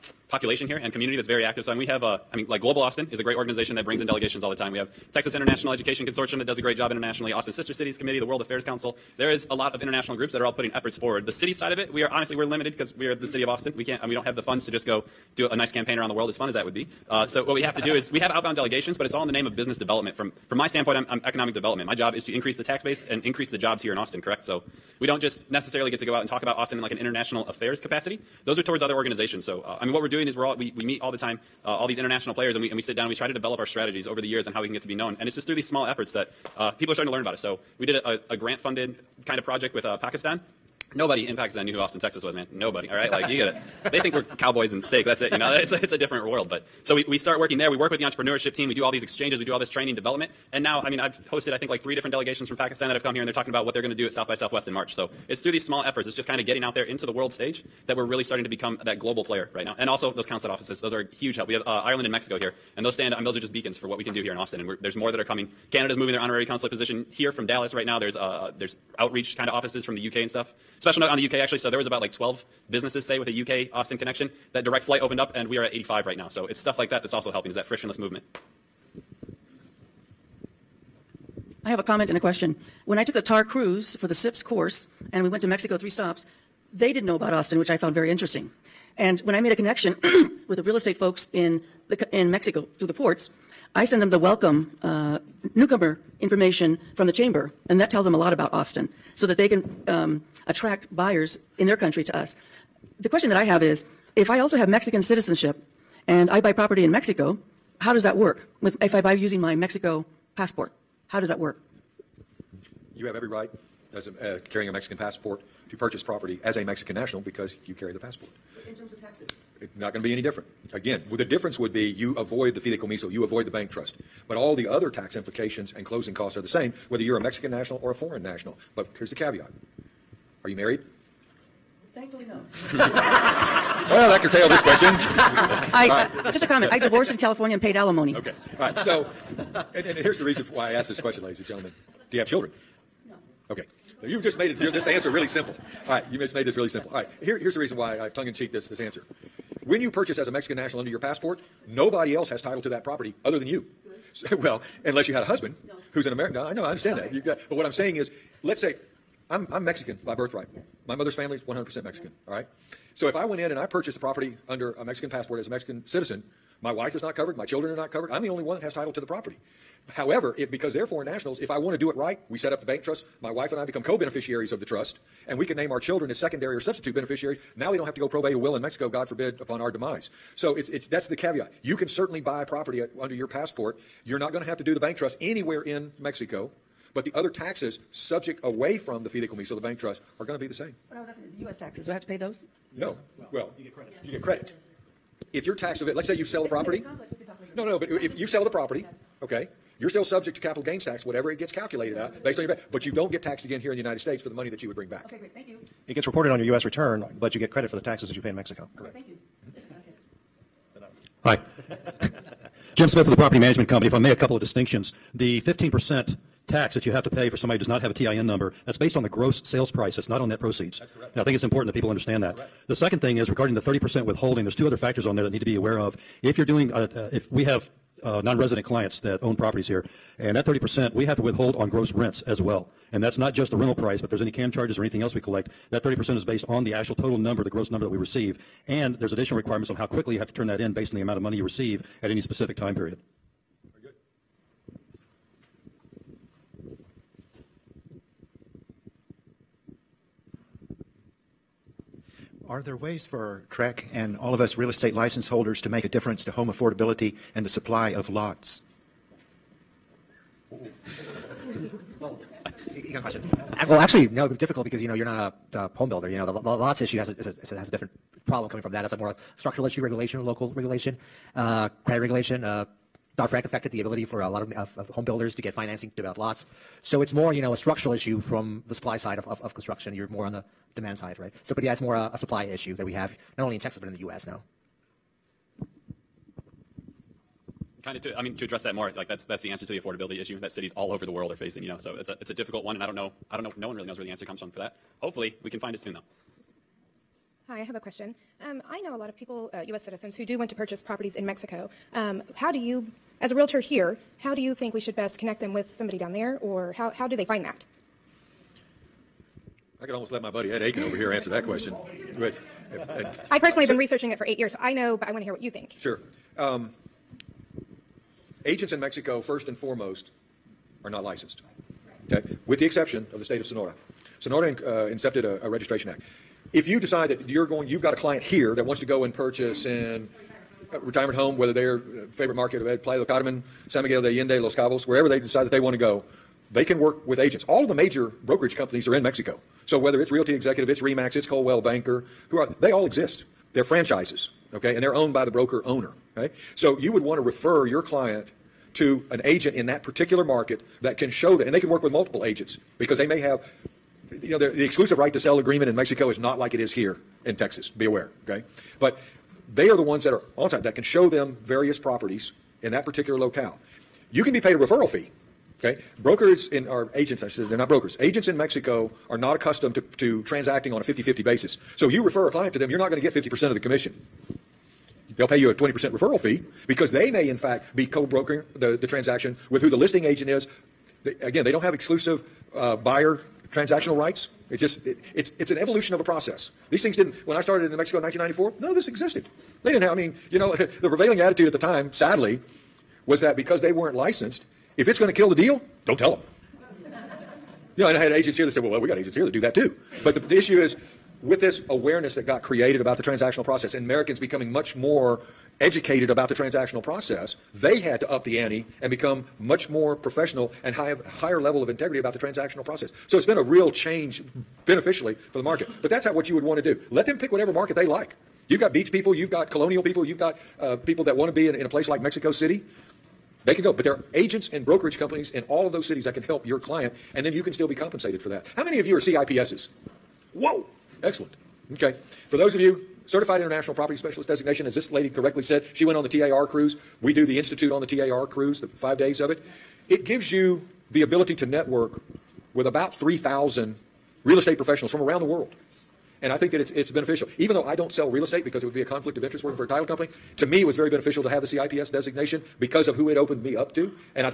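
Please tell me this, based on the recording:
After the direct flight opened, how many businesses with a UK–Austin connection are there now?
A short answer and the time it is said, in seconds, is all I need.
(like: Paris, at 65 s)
85, at 75 s.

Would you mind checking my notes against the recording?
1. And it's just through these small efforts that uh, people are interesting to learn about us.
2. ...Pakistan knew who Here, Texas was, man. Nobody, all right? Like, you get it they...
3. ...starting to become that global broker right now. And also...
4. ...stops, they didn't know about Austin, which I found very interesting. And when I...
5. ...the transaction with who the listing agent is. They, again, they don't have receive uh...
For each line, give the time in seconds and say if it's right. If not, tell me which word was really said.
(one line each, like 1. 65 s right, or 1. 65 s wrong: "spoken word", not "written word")
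1. 35 s wrong: "starting", not "interesting"
2. 41 s wrong: "Austin", not "Here"
3. 58 s wrong: "player", not "broker"
4. 85 s right
5. 378 s wrong: "exclusive", not "receive".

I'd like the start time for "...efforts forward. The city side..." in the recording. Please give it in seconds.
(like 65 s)
10 s.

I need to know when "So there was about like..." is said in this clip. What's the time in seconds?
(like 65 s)
71 s.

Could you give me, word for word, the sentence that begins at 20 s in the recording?
From from my standpoint, I'm, I'm economic development.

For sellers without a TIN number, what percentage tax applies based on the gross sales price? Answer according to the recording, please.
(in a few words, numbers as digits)
15%.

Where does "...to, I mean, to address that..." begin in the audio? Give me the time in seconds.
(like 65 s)
288 s.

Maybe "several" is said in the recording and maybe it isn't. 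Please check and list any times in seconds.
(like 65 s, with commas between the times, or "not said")
not said.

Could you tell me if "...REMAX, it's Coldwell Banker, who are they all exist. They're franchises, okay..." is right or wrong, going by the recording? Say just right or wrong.
right.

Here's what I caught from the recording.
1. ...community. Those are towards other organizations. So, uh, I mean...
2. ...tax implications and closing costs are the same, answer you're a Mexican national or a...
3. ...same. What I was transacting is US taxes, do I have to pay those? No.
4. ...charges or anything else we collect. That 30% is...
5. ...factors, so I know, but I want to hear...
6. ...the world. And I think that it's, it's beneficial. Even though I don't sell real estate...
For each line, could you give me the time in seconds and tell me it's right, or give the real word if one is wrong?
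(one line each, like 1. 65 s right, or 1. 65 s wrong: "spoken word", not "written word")
1. 27 s wrong: "capacity", not "community"
2. 124 s wrong: "whether", not "answer"
3. 190 s wrong: "asking", not "transacting"
4. 234 s right
5. 314 s wrong: "years", not "factors"
6. 445 s right.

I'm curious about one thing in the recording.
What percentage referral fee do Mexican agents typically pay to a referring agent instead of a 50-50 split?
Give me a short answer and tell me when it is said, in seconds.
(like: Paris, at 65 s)
20%, at 375 s.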